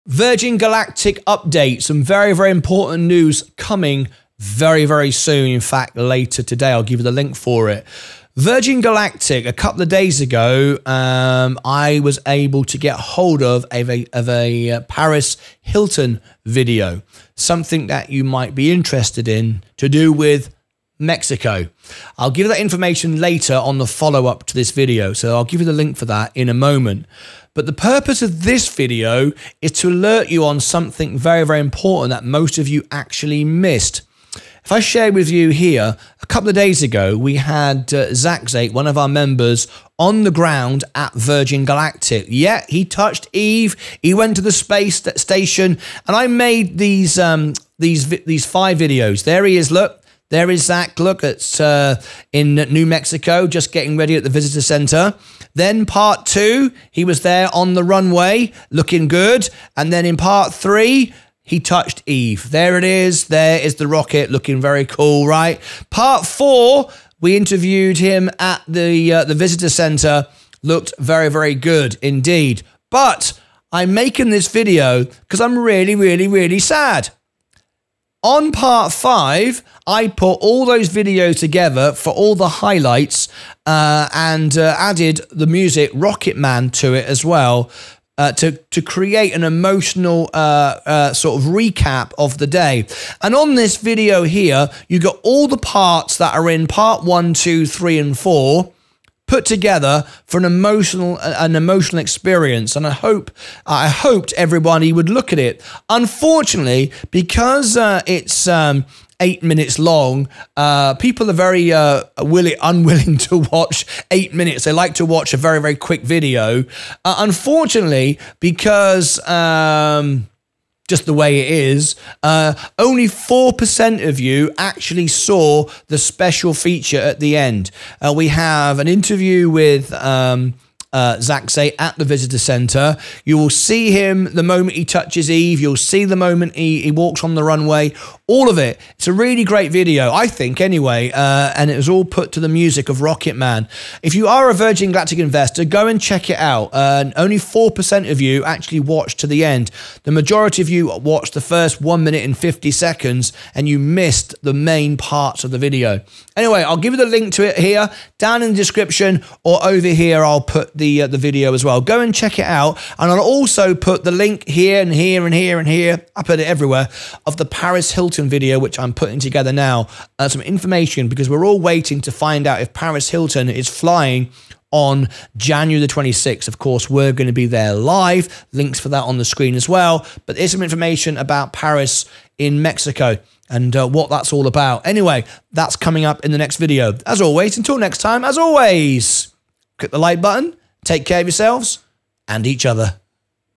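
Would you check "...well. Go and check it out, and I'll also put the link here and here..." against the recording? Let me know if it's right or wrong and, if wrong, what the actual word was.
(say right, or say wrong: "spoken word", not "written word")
right.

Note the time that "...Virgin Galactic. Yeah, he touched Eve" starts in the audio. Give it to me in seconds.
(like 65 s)
41 s.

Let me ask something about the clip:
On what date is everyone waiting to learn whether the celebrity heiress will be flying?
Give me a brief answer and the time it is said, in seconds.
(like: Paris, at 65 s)
January 26, at 175 s.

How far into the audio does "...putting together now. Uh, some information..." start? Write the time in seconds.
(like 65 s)
168 s.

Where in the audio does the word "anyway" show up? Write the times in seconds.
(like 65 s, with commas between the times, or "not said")
140 s, 156 s, 184 s.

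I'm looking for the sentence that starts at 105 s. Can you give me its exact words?
Unfortunately, because uh, it's um, eight minutes long.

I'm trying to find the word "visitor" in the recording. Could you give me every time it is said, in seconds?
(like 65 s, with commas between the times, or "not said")
54 s, 69 s, 132 s.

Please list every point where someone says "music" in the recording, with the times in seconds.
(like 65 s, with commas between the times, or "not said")
85 s, 142 s.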